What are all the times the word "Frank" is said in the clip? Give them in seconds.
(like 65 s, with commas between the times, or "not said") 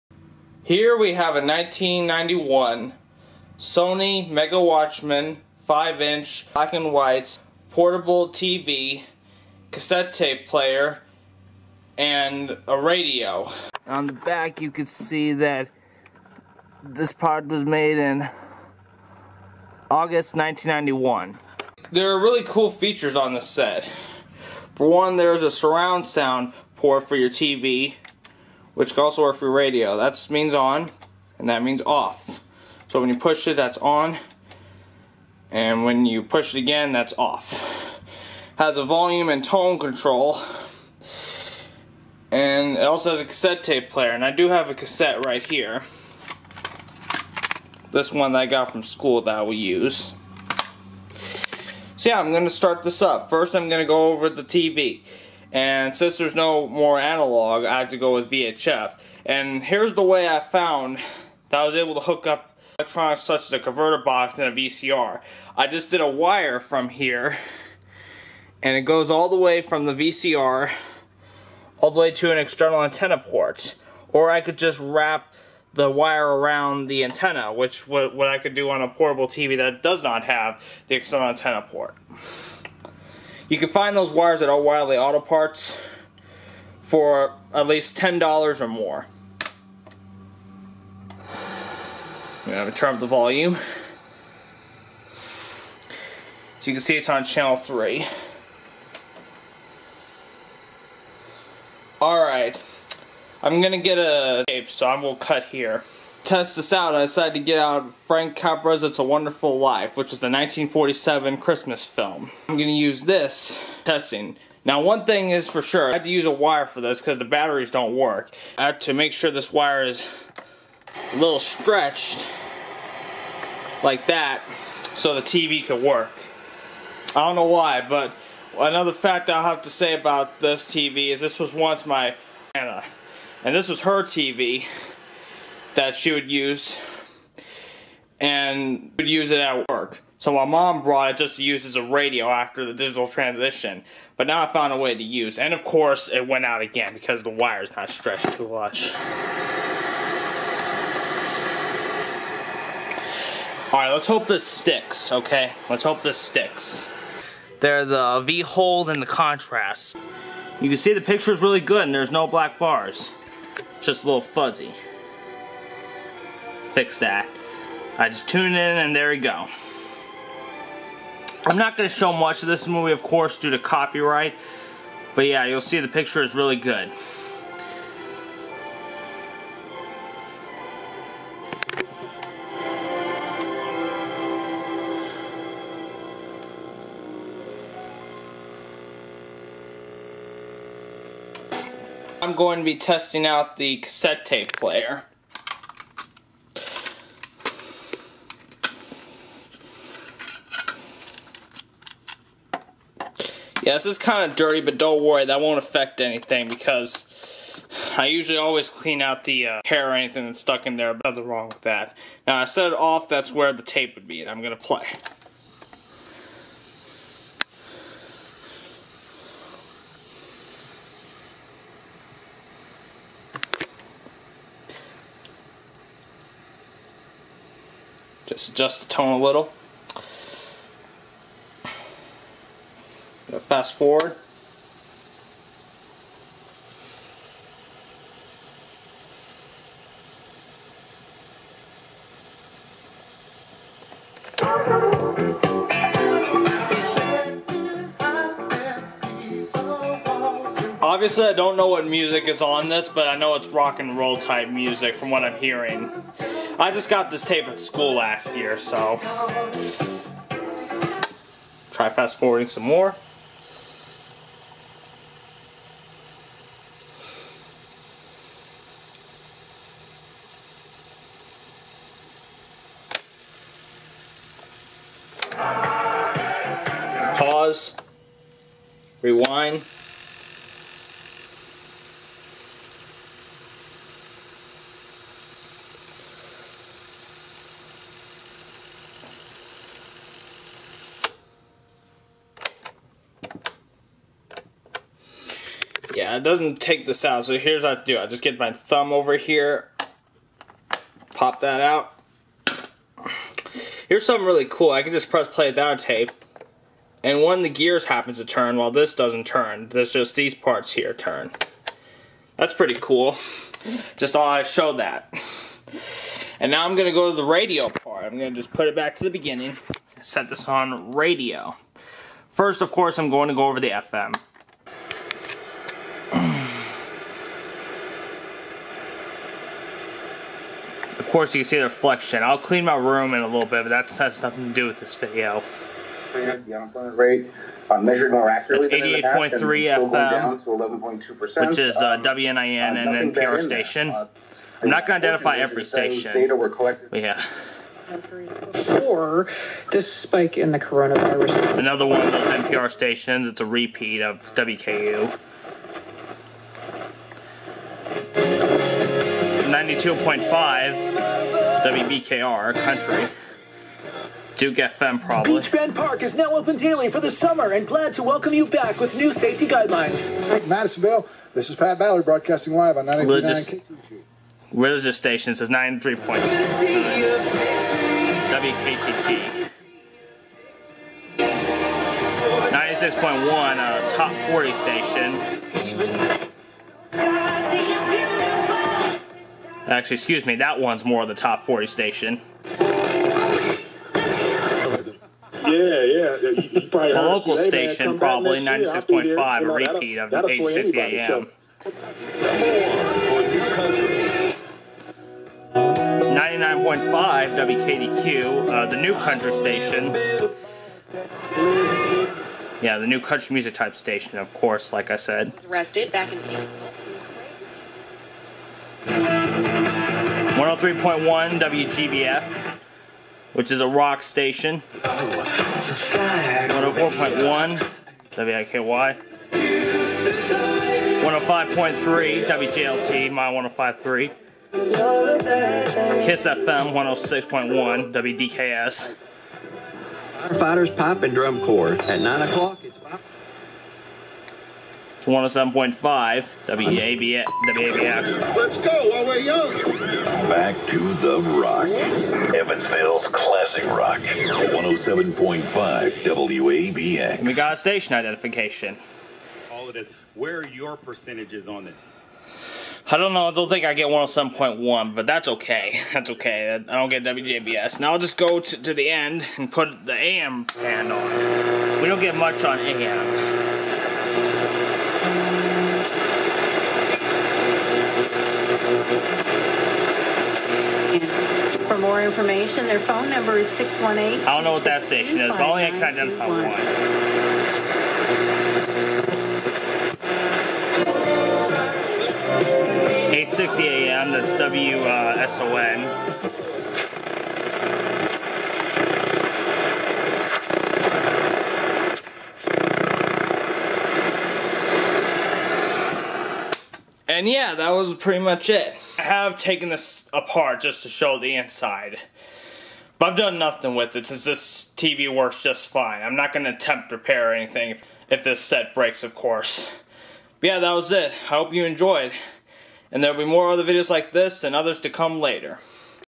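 107 s.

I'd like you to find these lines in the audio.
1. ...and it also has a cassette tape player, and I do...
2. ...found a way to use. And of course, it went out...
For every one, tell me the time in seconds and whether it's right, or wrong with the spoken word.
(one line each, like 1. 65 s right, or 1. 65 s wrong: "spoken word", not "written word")
1. 42 s right
2. 144 s right.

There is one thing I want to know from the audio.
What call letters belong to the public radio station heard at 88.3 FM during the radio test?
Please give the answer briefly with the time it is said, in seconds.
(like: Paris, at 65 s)
WNIN, at 341 s.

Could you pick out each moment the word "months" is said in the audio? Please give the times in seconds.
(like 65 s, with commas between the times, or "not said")
not said.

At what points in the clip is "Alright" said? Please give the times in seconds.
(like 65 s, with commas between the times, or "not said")
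102 s, 153 s.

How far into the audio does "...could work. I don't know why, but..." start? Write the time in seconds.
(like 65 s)
125 s.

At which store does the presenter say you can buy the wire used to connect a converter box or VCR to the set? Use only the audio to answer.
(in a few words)
O'Reilly Auto Parts.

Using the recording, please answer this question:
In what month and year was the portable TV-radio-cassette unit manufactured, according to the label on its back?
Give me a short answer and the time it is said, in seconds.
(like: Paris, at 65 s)
August 1991, at 19 s.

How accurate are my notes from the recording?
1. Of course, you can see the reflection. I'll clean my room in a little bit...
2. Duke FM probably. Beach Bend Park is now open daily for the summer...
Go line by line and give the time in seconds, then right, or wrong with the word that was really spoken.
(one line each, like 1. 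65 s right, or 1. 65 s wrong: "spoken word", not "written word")
1. 330 s right
2. 364 s right.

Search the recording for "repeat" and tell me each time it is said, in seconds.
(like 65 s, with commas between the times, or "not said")
353 s, 399 s.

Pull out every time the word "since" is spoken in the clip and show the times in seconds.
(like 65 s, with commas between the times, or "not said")
55 s, 514 s.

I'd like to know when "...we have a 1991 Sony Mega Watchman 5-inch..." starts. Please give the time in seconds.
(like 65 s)
0 s.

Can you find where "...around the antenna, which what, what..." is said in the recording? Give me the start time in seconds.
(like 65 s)
76 s.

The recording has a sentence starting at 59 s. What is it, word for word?
And here's the way I found that I was able to hook up electronics such as a converter box and a VCR.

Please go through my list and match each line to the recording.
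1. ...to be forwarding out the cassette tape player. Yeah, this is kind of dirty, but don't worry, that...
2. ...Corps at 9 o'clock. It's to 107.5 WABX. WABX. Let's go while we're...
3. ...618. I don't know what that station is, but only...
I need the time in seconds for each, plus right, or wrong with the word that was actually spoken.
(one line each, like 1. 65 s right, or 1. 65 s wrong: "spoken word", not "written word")
1. 192 s wrong: "testing", not "forwarding"
2. 441 s right
3. 483 s right.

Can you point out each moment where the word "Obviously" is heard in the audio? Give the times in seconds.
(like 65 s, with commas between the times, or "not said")
250 s.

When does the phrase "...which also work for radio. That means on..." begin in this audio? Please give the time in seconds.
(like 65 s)
28 s.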